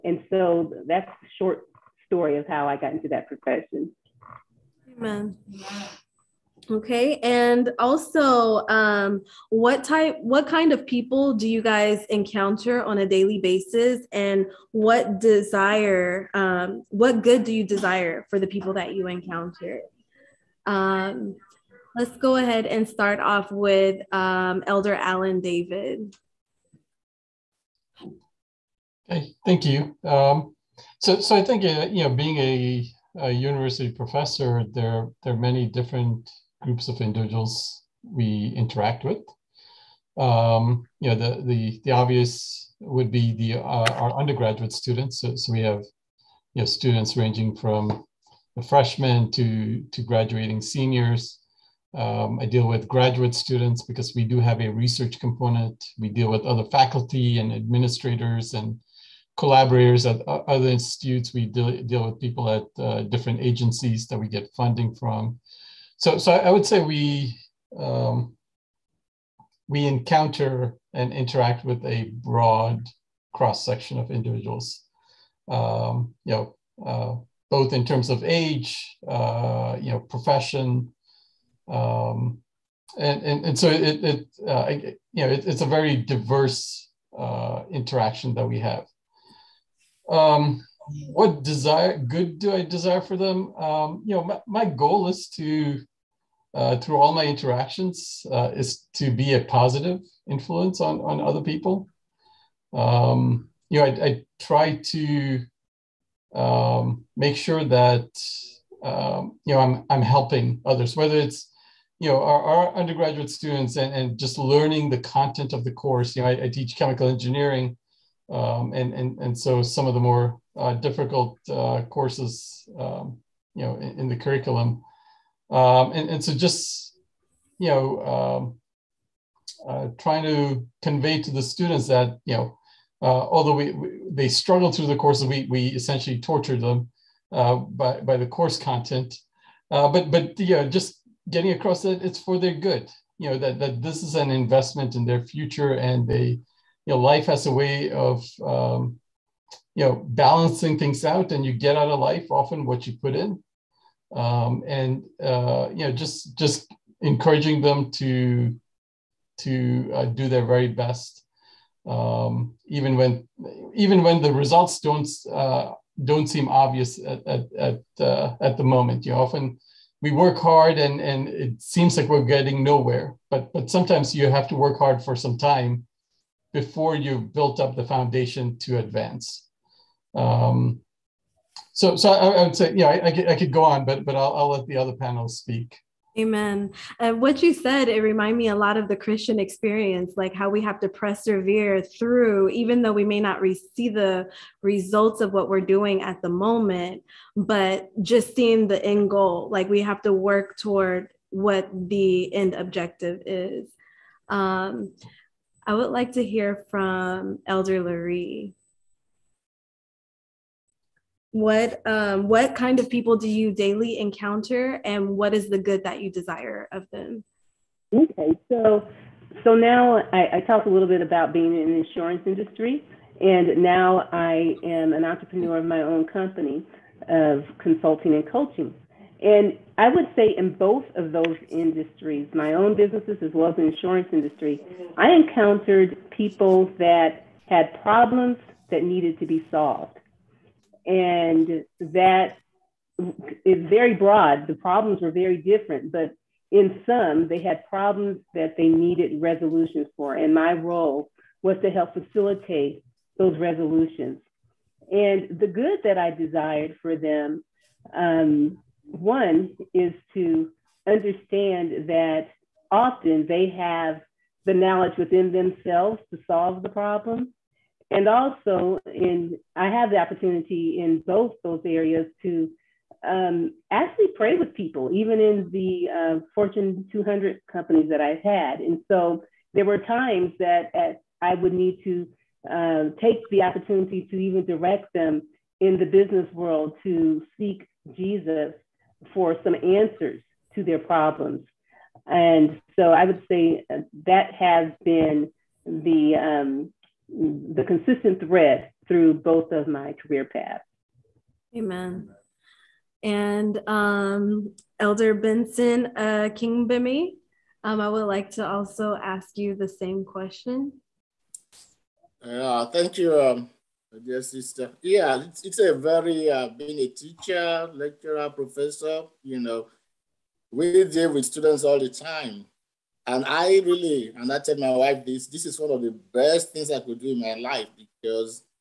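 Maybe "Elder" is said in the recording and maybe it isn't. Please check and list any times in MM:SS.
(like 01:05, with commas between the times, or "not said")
00:24, 03:27, 05:04.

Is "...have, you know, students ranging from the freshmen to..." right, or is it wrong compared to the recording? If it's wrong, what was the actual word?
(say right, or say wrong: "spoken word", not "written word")
right.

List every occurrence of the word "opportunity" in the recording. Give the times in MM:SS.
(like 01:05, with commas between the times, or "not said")
04:29, 04:43.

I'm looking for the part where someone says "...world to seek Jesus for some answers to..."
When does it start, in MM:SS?
04:46.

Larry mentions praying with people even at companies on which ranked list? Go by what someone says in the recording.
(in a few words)
Fortune 200.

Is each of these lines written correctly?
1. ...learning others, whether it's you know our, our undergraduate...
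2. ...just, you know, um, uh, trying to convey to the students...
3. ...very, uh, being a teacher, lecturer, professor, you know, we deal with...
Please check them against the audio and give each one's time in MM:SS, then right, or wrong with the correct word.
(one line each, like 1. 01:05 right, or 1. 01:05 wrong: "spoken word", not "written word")
1. 01:50 wrong: "helping", not "learning"
2. 02:06 right
3. 05:15 right.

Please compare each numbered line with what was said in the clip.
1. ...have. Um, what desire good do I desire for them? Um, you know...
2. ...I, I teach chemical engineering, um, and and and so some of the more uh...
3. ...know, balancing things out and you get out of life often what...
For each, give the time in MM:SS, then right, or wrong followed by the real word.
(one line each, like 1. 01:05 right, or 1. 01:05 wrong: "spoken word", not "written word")
1. 01:28 right
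2. 01:56 right
3. 02:29 right.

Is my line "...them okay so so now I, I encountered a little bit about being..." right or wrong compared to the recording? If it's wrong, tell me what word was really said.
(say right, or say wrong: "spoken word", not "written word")
wrong: "talked", not "encountered".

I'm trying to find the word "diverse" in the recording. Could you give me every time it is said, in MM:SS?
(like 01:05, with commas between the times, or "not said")
01:25.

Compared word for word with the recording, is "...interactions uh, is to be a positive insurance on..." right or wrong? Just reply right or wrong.
wrong.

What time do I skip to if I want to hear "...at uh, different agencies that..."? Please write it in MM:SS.
01:02.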